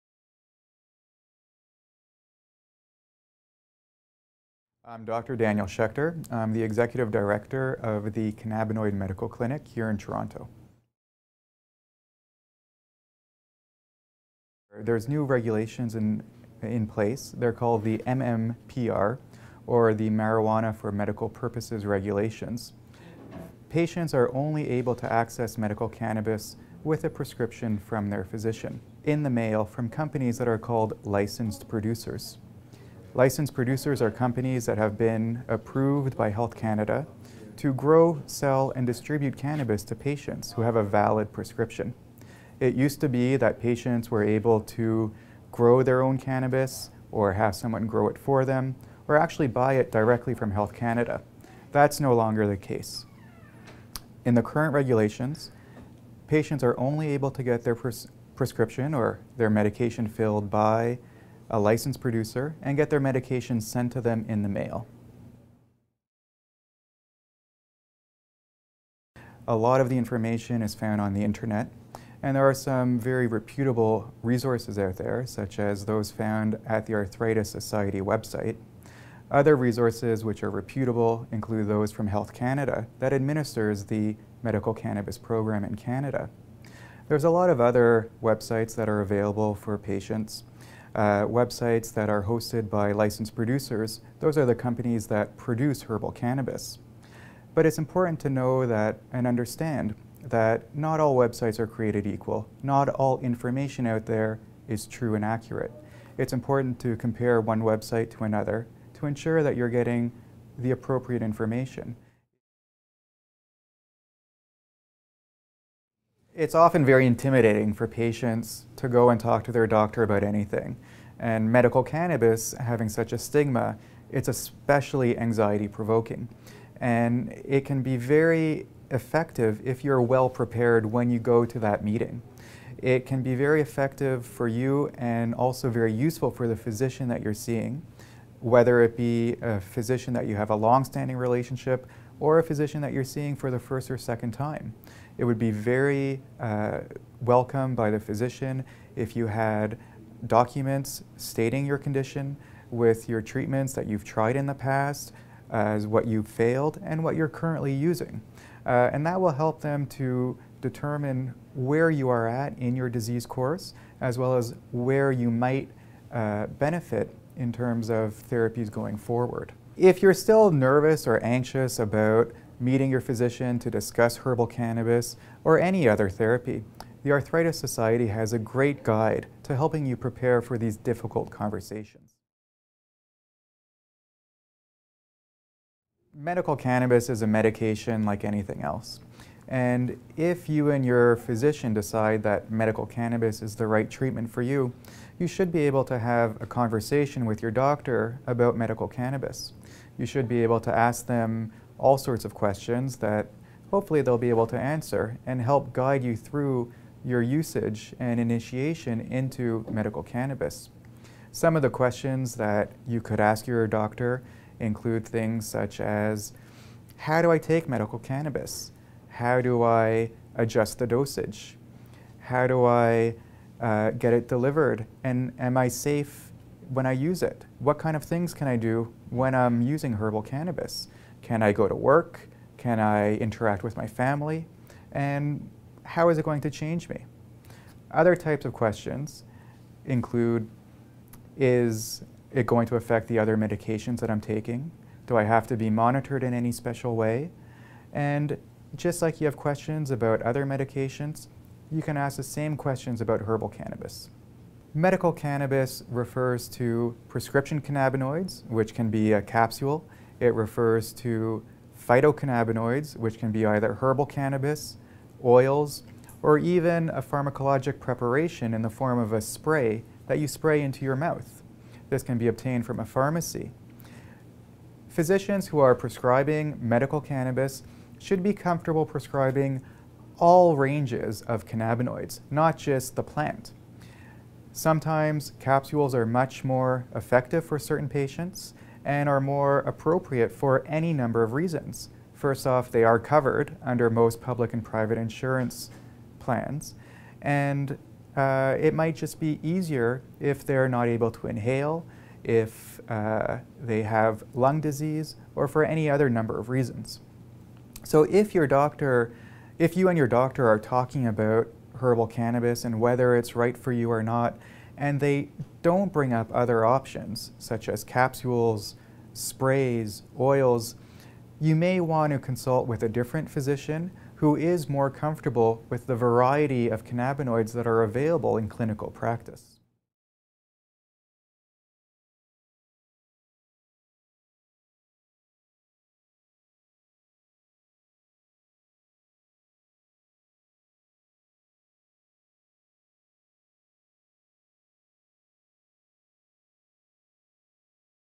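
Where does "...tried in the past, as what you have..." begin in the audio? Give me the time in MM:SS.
02:34.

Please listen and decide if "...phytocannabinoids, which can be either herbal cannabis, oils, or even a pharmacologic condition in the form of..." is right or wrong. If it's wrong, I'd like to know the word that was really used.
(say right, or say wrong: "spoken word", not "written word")
wrong: "preparation", not "condition".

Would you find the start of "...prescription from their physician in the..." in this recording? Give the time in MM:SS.
00:27.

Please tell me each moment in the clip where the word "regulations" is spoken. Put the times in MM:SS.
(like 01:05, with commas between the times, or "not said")
00:15, 00:21, 00:54.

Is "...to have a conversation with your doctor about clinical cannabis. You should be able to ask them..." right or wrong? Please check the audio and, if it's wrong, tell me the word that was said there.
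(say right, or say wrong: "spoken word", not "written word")
wrong: "medical", not "clinical".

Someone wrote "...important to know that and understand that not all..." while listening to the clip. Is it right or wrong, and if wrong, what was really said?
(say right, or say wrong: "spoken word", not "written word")
right.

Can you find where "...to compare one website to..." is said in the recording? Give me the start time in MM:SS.
01:46.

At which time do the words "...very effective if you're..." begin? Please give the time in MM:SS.
02:07.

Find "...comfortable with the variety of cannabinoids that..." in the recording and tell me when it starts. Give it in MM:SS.
05:24.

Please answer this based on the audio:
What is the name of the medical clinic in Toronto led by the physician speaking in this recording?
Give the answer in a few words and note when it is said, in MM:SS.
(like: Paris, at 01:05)
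Cannabinoid Medical Clinic, at 00:08.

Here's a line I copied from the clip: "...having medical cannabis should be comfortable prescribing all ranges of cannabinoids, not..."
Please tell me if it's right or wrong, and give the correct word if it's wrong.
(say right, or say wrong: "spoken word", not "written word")
wrong: "prescribing", not "having".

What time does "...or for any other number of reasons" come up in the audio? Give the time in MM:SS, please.
05:05.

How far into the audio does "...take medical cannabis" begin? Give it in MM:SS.
03:37.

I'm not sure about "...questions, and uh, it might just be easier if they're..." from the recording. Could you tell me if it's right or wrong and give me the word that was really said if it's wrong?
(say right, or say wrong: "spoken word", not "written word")
wrong: "plans", not "questions".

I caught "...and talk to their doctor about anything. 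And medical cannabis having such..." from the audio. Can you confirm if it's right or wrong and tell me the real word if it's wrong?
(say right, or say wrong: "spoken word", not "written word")
right.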